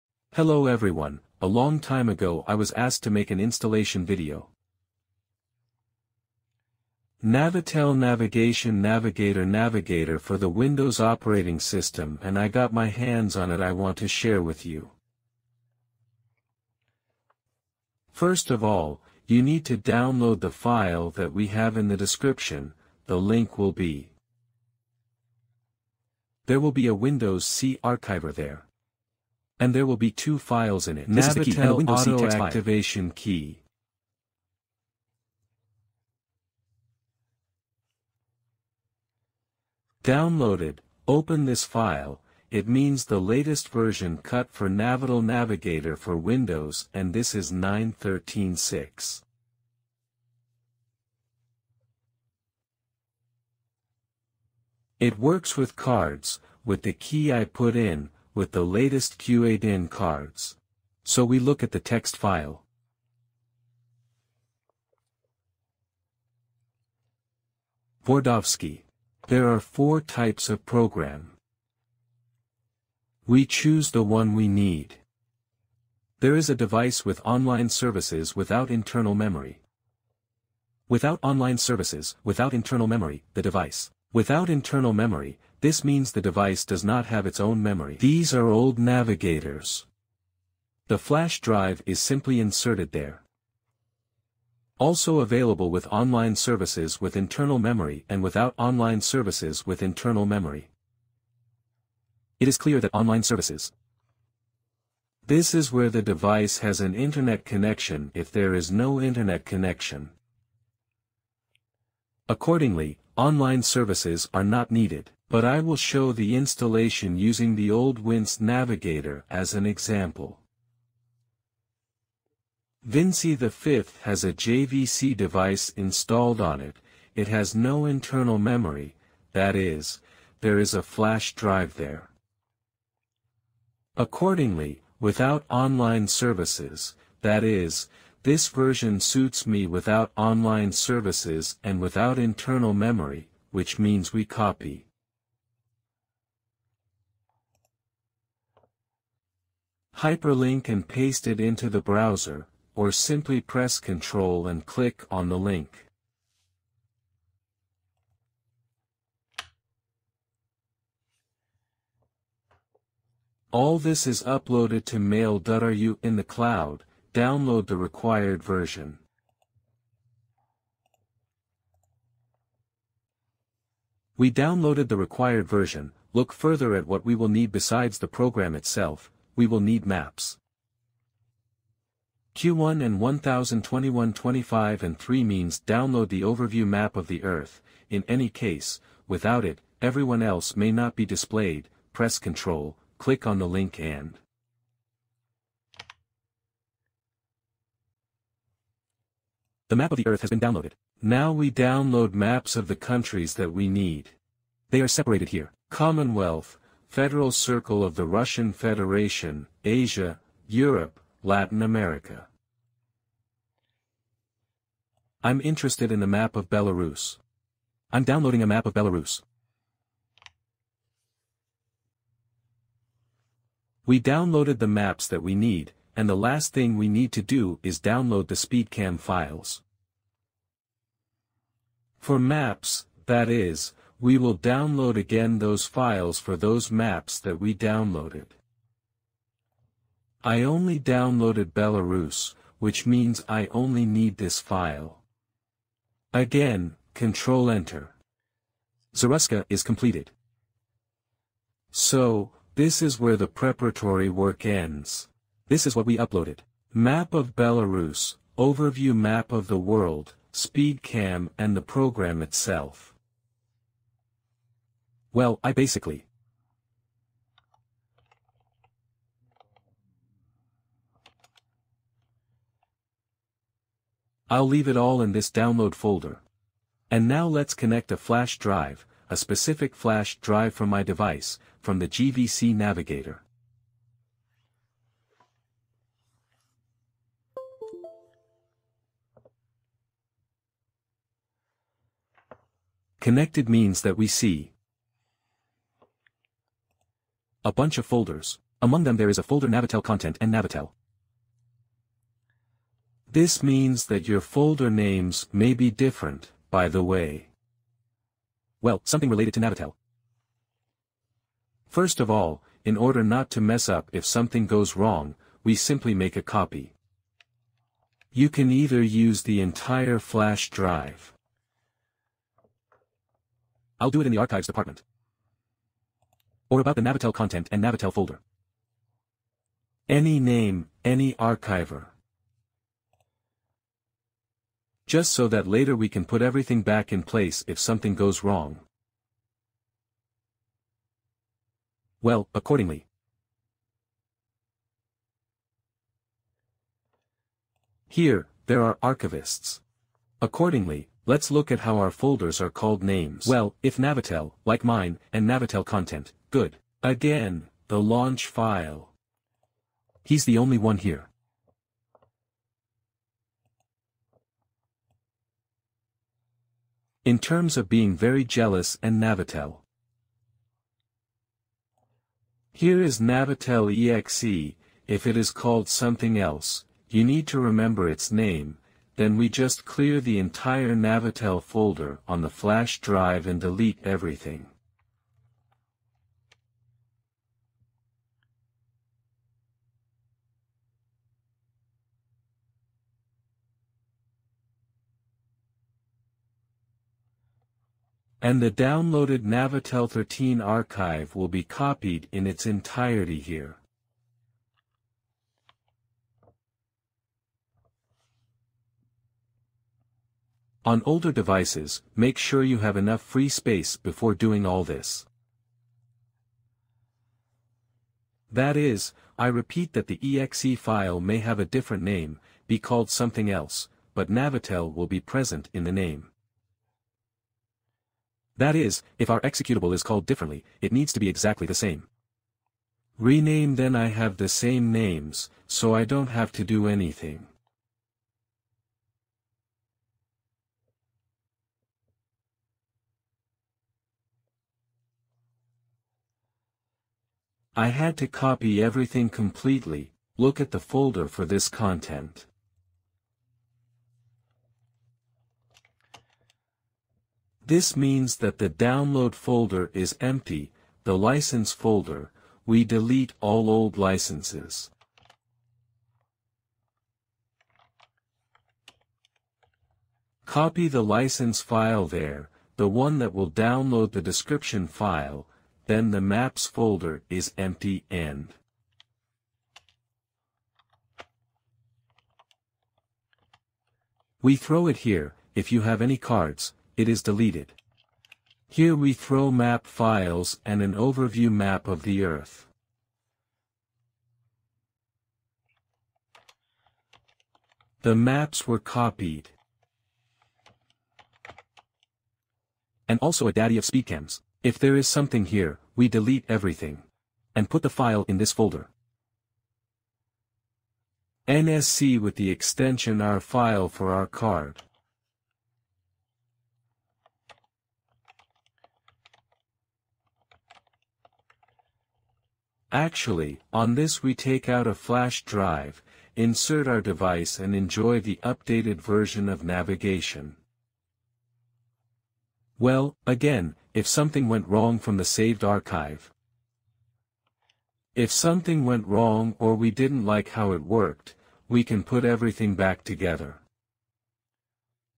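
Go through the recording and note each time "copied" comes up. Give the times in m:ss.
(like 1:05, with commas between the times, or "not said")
6:41, 8:18.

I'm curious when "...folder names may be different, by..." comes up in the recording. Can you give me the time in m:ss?
5:04.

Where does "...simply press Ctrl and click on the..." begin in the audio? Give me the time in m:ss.
2:32.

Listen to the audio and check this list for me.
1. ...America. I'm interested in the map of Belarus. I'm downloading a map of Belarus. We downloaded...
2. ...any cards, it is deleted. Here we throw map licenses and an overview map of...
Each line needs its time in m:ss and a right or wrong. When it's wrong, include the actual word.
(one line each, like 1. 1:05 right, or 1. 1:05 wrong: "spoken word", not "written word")
1. 3:31 right
2. 8:05 wrong: "files", not "licenses".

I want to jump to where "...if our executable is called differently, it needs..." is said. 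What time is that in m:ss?
7:08.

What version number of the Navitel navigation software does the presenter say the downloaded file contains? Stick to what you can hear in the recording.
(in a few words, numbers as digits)
9.13.6.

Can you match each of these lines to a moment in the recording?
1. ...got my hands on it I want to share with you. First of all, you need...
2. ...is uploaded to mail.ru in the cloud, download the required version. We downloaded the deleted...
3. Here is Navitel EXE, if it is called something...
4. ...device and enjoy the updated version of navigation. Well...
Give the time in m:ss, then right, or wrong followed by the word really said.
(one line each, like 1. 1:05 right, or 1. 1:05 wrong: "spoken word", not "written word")
1. 0:12 right
2. 2:44 wrong: "required", not "deleted"
3. 6:12 right
4. 8:46 right.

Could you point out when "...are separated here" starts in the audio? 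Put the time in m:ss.
3:24.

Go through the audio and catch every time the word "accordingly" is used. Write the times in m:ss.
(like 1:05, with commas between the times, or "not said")
1:52, 2:13, 5:42, 5:50.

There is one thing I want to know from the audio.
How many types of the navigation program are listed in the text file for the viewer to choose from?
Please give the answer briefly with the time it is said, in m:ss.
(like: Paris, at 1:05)
4, at 1:09.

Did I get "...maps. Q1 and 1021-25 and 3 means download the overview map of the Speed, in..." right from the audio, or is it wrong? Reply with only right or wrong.
wrong.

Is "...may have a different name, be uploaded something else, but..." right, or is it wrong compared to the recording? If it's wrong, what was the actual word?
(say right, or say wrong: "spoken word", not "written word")
wrong: "called", not "uploaded".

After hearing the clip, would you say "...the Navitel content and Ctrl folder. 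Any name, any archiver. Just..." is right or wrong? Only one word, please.
wrong.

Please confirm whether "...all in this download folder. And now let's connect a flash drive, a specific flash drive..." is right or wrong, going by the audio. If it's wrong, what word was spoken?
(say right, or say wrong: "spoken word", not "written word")
right.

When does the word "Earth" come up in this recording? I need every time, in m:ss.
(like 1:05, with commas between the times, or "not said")
3:07, 3:20, 8:12.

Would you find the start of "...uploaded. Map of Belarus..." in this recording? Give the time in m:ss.
4:15.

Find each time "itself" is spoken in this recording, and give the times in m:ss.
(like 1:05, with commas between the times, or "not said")
2:58, 4:22.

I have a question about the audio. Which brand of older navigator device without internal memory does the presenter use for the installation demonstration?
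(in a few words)
JVC.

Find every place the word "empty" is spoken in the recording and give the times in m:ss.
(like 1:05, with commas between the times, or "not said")
7:39, 7:57.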